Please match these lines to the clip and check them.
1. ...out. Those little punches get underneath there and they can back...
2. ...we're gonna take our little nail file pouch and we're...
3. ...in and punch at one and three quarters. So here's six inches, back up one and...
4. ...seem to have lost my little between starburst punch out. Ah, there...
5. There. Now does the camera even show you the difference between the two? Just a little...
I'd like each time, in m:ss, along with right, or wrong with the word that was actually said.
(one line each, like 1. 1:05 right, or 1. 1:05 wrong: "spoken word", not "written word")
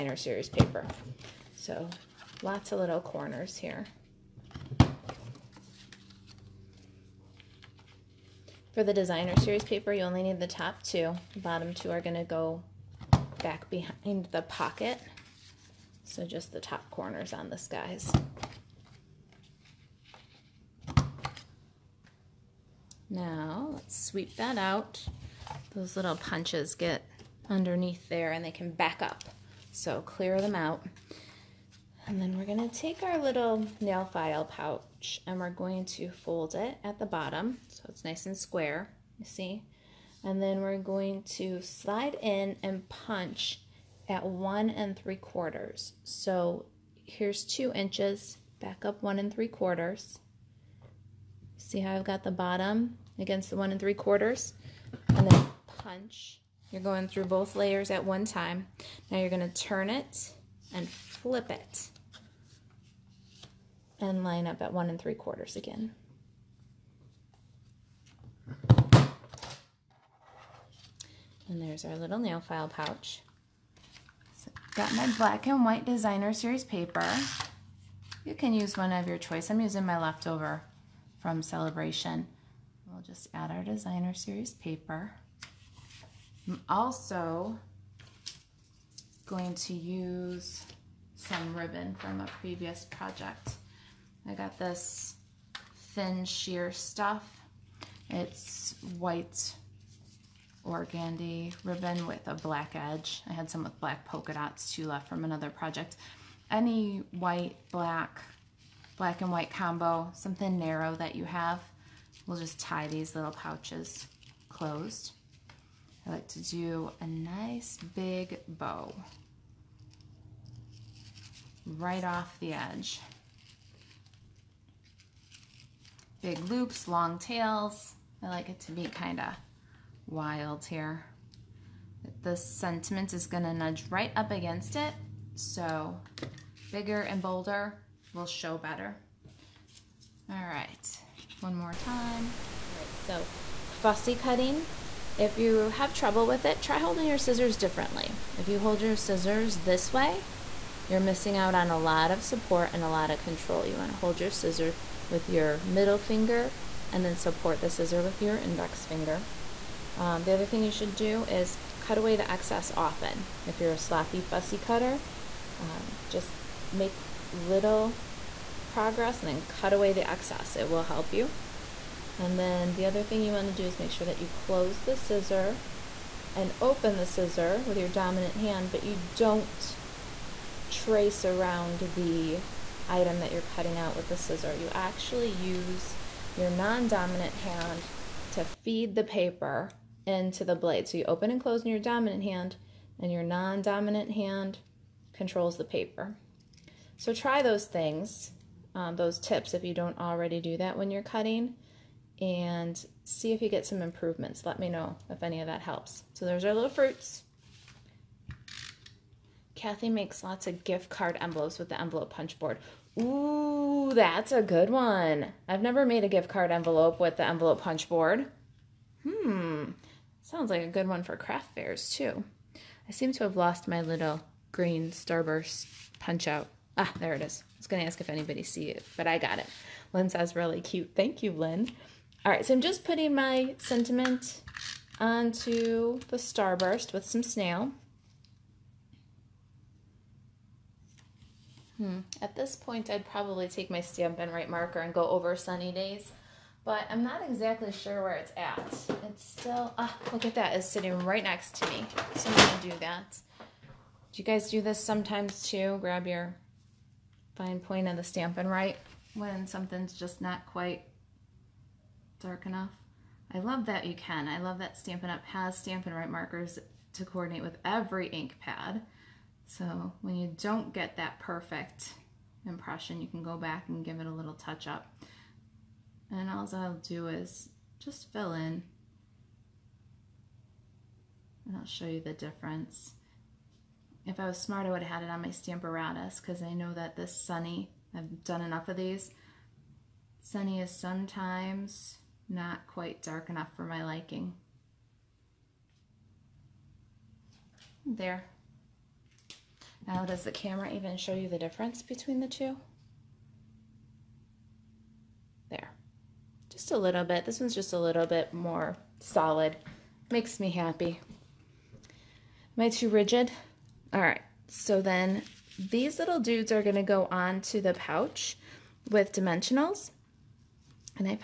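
1. 0:24 right
2. 0:32 right
3. 0:42 wrong: "two", not "six"
4. 3:42 wrong: "green", not "between"
5. 4:57 right.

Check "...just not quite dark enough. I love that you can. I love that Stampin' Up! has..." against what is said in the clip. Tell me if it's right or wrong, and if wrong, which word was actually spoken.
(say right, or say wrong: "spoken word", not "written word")
right.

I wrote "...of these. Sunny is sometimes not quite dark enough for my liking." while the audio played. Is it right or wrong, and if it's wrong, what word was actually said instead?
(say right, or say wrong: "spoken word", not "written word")
right.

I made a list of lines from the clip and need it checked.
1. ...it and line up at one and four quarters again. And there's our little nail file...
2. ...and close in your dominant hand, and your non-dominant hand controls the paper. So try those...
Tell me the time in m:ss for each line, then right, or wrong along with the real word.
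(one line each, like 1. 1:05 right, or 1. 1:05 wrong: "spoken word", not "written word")
1. 1:01 wrong: "three", not "four"
2. 3:11 right.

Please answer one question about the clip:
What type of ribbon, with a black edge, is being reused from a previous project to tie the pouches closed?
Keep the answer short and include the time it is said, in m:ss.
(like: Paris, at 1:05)
White organdy ribbon, at 1:38.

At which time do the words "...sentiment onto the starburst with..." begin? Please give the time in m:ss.
3:53.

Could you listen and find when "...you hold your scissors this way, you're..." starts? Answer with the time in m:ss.
2:28.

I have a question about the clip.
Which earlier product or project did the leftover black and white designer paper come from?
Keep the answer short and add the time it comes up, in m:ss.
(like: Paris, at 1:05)
Celebration, at 1:21.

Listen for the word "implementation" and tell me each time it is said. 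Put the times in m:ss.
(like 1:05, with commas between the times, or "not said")
not said.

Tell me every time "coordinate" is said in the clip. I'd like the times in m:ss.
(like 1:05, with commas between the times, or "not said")
4:27.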